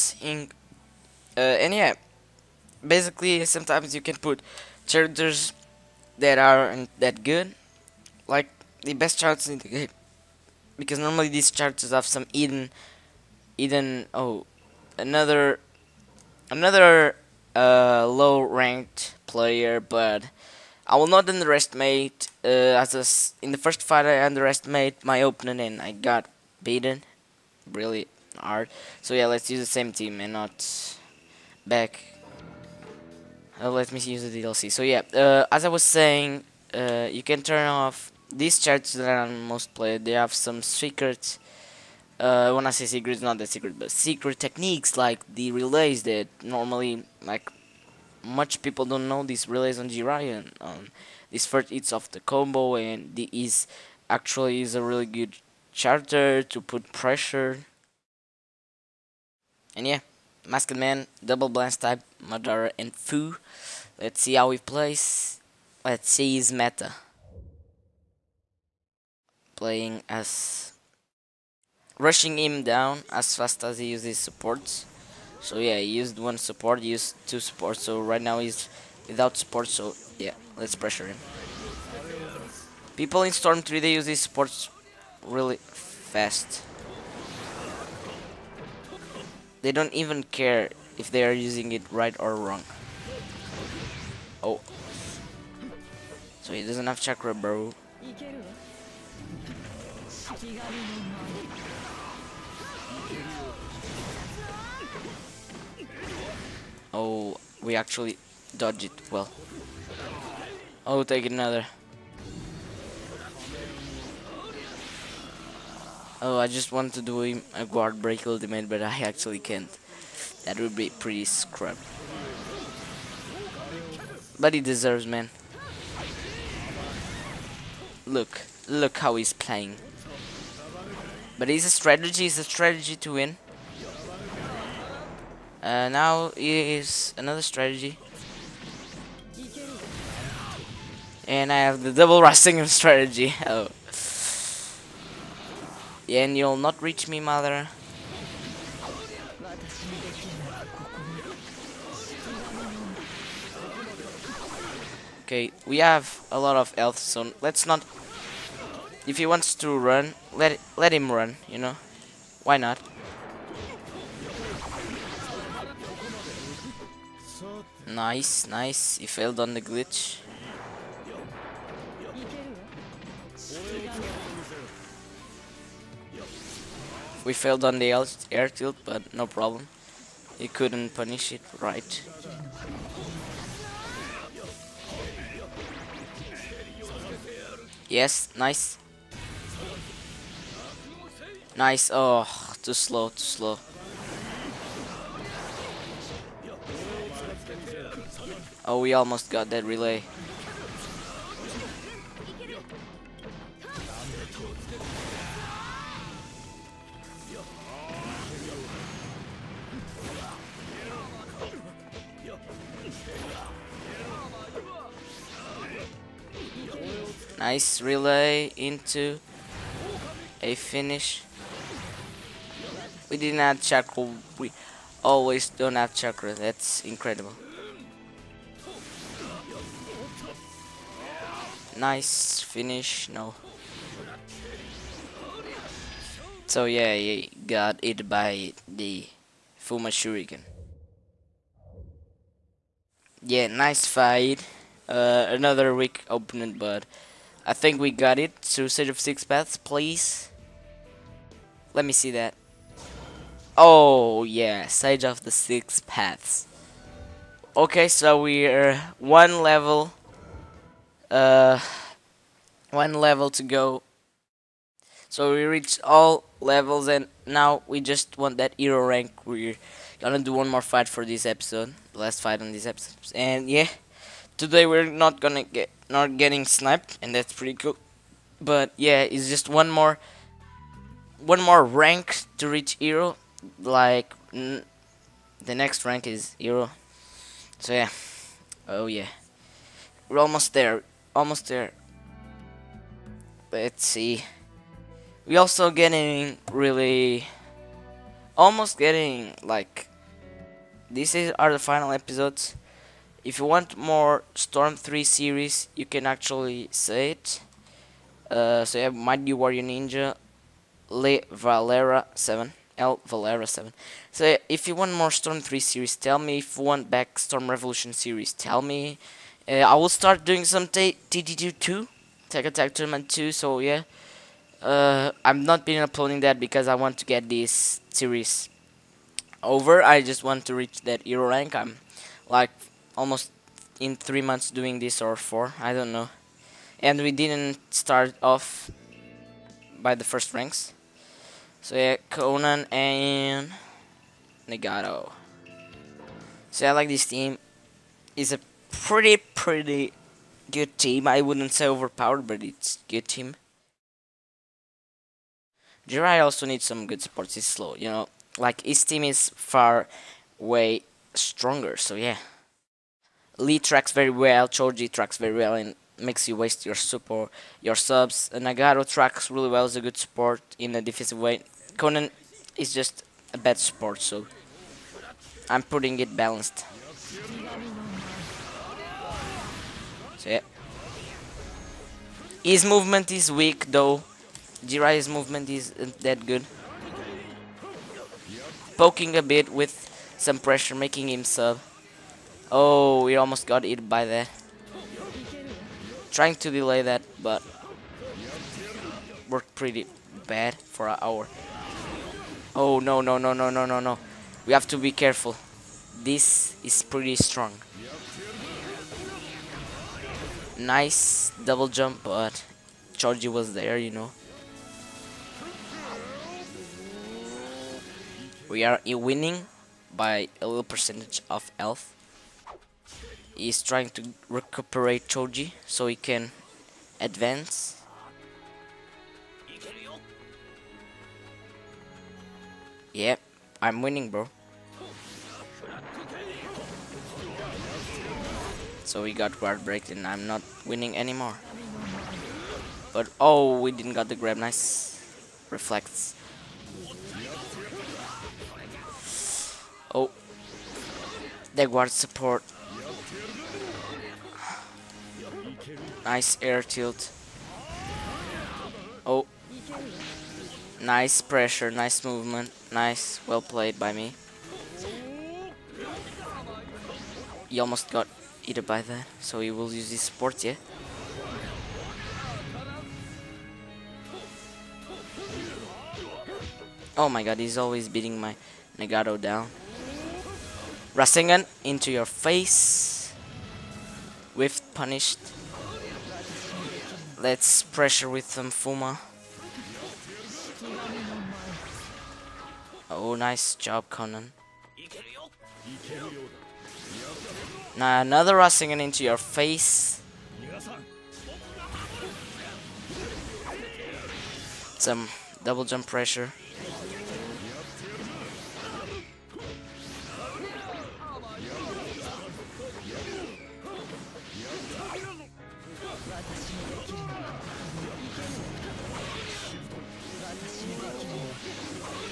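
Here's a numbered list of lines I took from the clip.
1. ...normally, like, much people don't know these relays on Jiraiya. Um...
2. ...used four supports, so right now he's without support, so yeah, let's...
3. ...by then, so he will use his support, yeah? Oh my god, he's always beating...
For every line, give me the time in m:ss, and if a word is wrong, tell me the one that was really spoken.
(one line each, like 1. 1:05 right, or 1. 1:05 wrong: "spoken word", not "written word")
1. 0:46 right
2. 1:16 wrong: "two", not "four"
3. 7:48 right.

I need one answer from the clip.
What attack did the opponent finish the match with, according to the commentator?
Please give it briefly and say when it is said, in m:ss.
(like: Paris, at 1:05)
Fuma Shuriken, at 3:59.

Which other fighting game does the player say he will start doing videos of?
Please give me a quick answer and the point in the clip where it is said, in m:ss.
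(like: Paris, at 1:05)
Tekken Tag Tournament 2, at 5:22.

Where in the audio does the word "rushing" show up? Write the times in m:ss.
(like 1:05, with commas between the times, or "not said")
1:11, 8:18.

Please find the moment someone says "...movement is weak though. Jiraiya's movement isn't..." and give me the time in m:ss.
6:22.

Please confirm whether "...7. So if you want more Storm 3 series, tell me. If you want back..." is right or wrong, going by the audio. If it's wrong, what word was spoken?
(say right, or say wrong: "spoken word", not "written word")
right.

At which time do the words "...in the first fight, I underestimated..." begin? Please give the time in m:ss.
0:23.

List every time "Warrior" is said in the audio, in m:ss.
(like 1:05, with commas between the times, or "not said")
5:09.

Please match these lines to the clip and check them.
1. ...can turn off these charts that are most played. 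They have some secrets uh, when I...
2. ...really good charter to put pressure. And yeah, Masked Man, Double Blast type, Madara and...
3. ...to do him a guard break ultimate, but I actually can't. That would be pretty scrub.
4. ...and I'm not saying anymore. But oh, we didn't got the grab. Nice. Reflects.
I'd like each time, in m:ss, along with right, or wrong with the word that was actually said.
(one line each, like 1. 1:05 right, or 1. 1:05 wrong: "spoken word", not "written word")
1. 0:37 right
2. 0:54 right
3. 1:56 right
4. 7:19 wrong: "winning", not "saying".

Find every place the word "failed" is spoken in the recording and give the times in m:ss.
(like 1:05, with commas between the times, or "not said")
2:49, 2:57.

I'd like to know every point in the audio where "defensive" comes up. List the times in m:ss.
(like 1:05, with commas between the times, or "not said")
6:10.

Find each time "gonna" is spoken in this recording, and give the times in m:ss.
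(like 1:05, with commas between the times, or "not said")
4:30, 4:35.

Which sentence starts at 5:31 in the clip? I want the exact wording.
I'm like almost in three months doing this or four, I don't know.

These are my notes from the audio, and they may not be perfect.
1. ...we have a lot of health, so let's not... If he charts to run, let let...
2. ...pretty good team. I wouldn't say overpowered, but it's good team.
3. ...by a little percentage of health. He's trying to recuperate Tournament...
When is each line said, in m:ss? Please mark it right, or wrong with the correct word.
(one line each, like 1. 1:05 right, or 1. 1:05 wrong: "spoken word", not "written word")
1. 2:35 wrong: "wants", not "charts"
2. 5:49 right
3. 6:59 wrong: "Choji", not "Tournament".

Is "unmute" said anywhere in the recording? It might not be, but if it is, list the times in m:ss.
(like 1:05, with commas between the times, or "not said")
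not said.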